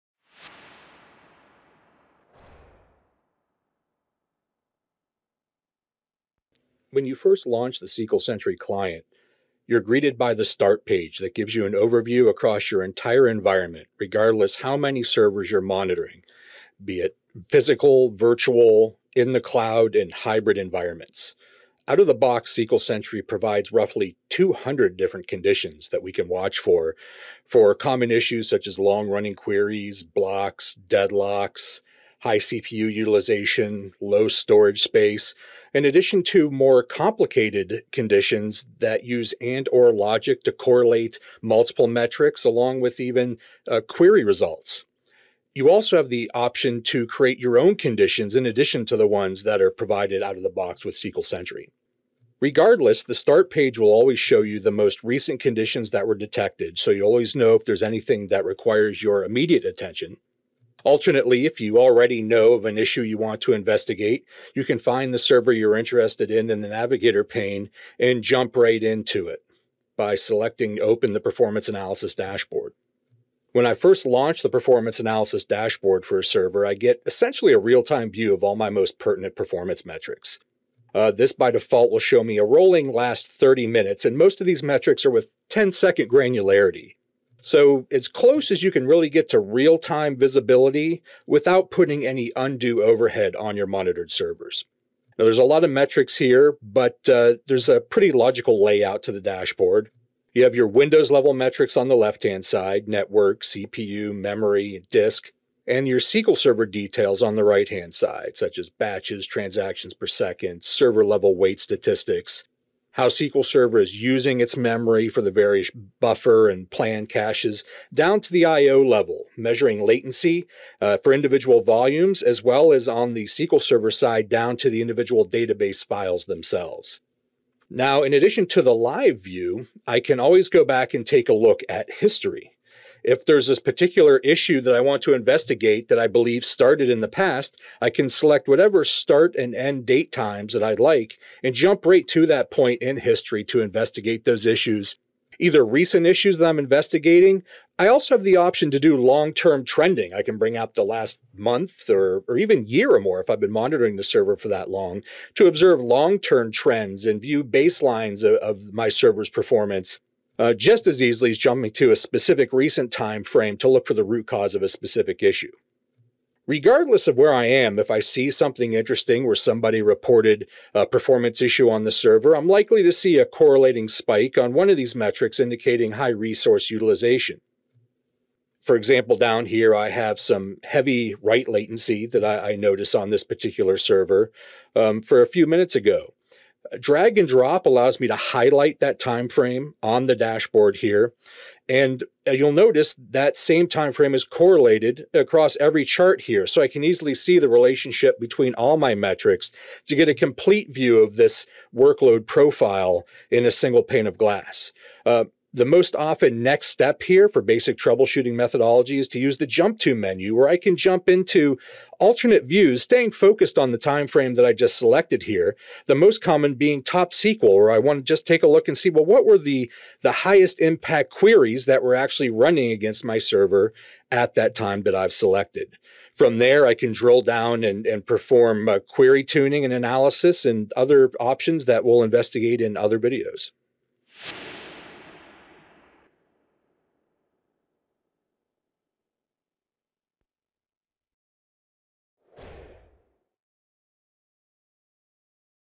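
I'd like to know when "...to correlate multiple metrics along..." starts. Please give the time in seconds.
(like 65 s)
40 s.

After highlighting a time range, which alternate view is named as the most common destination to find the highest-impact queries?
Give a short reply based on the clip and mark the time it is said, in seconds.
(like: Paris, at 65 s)
Top SQL, at 216 s.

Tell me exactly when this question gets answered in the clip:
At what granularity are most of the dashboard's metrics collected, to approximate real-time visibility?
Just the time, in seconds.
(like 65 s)
85 s.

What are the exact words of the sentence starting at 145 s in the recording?
Either recent issues that I'm investigating.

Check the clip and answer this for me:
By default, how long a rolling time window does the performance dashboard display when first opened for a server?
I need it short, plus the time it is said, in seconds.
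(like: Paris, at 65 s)
30 minutes, at 82 s.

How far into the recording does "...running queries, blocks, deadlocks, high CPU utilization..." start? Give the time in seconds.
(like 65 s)
29 s.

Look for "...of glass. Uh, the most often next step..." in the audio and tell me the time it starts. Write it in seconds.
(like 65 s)
204 s.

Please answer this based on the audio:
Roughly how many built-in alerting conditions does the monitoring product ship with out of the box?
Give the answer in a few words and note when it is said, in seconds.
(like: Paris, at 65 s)
200, at 23 s.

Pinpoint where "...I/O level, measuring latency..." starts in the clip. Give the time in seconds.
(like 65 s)
118 s.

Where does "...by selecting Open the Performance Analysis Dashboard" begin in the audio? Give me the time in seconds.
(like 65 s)
69 s.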